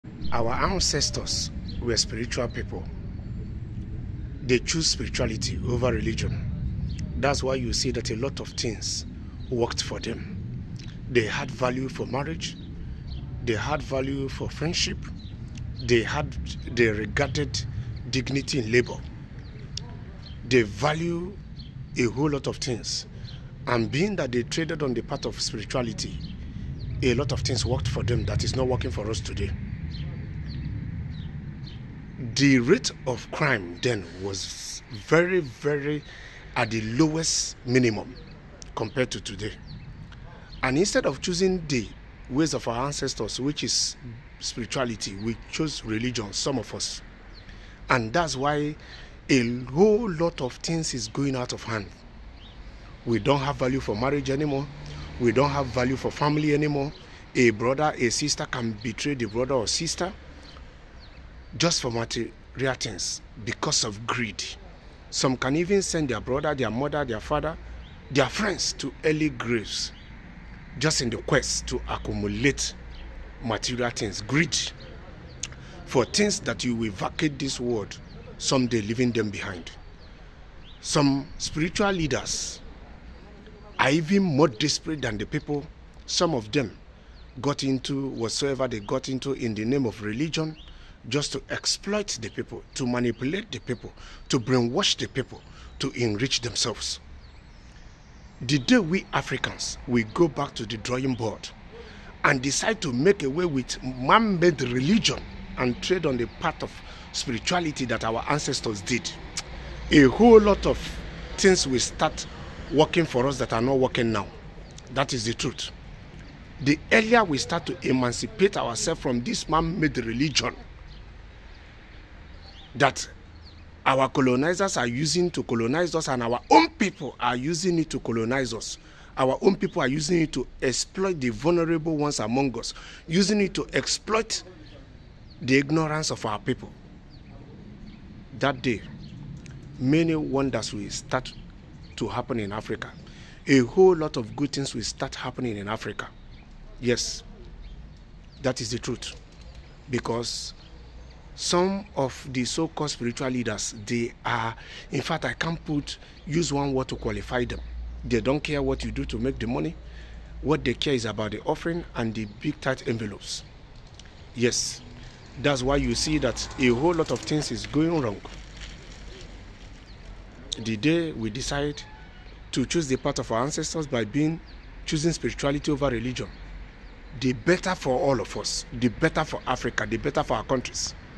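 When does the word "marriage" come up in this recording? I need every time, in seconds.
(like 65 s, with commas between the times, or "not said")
12 s, 53 s.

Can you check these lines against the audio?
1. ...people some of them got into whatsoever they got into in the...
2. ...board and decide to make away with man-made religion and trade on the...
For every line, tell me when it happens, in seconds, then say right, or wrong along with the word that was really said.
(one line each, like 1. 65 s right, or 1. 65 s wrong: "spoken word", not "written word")
1. 85 s right
2. 101 s right.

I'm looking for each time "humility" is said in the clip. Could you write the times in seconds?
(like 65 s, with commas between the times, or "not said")
not said.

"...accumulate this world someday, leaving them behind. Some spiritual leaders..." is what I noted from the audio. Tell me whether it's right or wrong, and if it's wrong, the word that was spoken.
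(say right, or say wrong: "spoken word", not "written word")
wrong: "vacate", not "accumulate".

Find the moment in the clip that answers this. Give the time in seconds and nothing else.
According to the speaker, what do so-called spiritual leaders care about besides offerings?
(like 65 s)
162 s.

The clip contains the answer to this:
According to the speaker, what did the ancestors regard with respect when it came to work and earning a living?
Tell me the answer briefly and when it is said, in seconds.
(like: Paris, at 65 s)
Dignity in labor, at 18 s.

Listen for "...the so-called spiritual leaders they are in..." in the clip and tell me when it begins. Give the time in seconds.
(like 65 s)
152 s.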